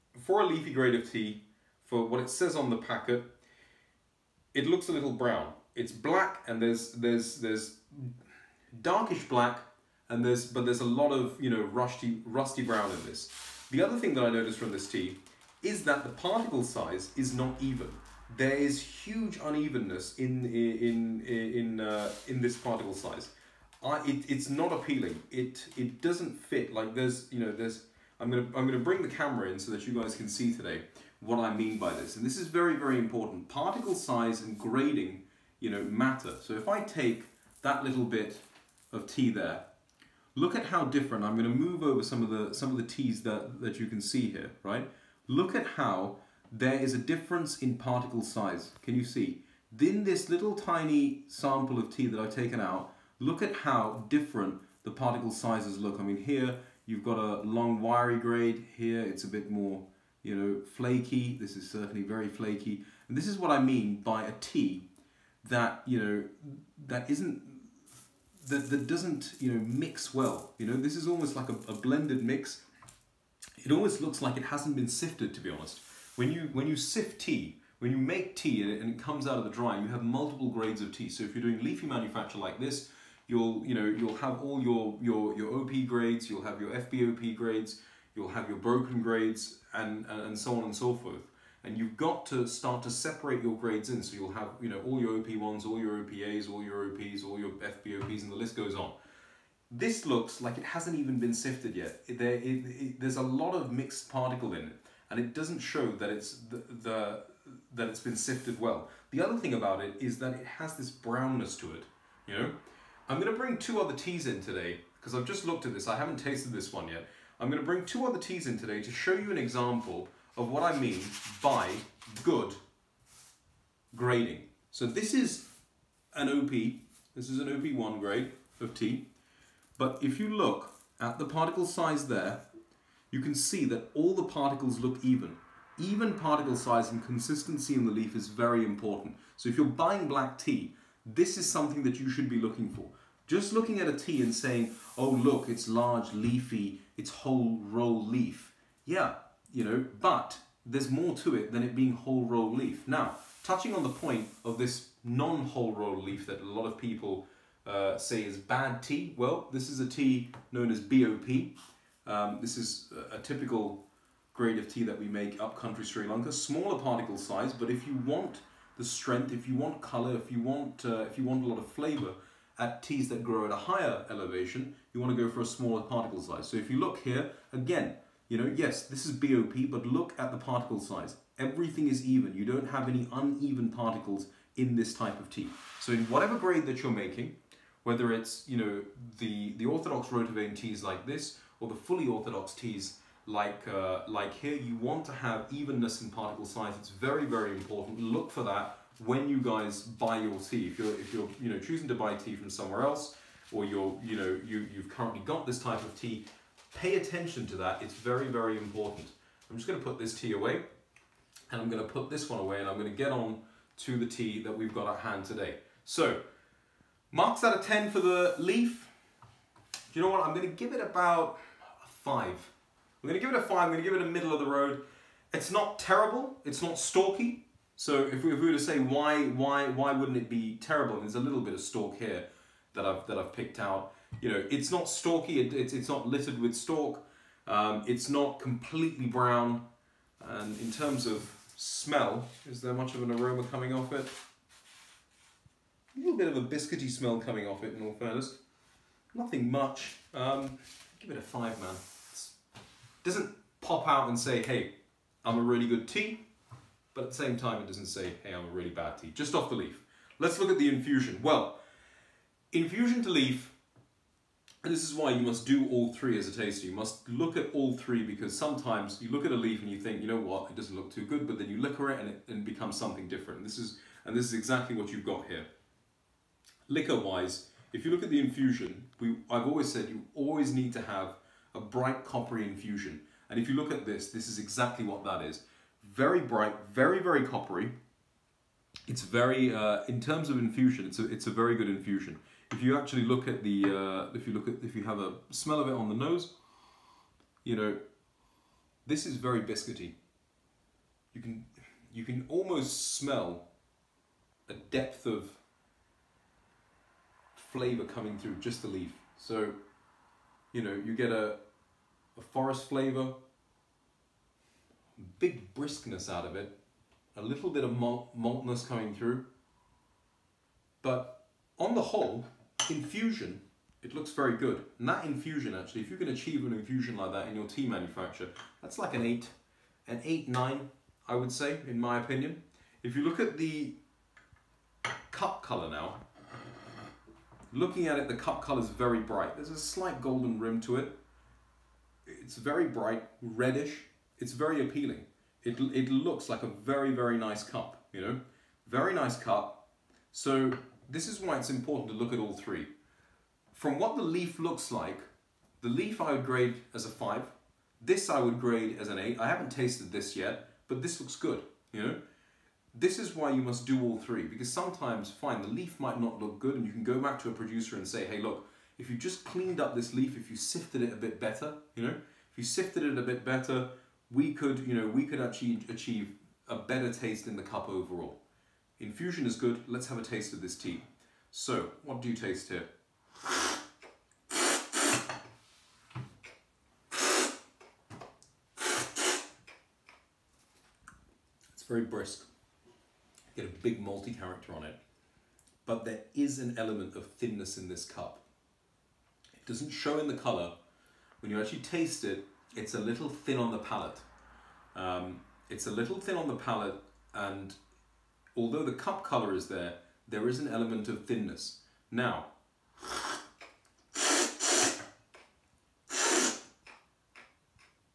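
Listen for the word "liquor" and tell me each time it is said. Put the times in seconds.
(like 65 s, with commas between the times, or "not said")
271 s, 276 s.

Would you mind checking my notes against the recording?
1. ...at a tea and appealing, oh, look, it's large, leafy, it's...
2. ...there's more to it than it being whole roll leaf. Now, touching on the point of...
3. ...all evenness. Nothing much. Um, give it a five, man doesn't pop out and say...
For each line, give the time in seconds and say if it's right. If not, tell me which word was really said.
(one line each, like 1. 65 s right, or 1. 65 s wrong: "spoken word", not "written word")
1. 143 s wrong: "saying", not "appealing"
2. 150 s right
3. 247 s wrong: "fairness", not "evenness".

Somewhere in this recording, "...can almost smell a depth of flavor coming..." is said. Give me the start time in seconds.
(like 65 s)
302 s.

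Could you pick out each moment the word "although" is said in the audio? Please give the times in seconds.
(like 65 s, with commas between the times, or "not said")
408 s.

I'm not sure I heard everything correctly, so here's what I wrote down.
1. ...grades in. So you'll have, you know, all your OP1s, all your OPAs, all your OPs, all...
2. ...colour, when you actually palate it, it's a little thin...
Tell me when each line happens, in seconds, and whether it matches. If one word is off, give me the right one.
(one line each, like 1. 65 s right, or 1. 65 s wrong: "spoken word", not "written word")
1. 93 s right
2. 400 s wrong: "taste", not "palate".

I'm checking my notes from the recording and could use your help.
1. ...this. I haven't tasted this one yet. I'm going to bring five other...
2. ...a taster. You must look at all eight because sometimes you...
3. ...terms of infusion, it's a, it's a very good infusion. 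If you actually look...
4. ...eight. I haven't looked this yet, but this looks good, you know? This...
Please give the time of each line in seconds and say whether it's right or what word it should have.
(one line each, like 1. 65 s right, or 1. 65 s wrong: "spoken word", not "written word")
1. 115 s wrong: "two", not "five"
2. 266 s wrong: "three", not "eight"
3. 289 s right
4. 358 s wrong: "tasted", not "looked".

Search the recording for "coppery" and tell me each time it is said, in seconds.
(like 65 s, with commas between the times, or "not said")
282 s, 287 s.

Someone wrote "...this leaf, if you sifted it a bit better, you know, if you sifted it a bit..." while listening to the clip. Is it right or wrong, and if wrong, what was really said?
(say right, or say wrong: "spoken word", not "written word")
right.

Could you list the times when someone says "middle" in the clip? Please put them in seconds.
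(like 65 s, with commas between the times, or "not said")
224 s.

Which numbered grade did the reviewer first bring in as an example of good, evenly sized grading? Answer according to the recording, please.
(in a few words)
OP1.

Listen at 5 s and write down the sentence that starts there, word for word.
It's black and there's there's there's darkish black and there's but there's a lot of you know rusty rusty brown in this.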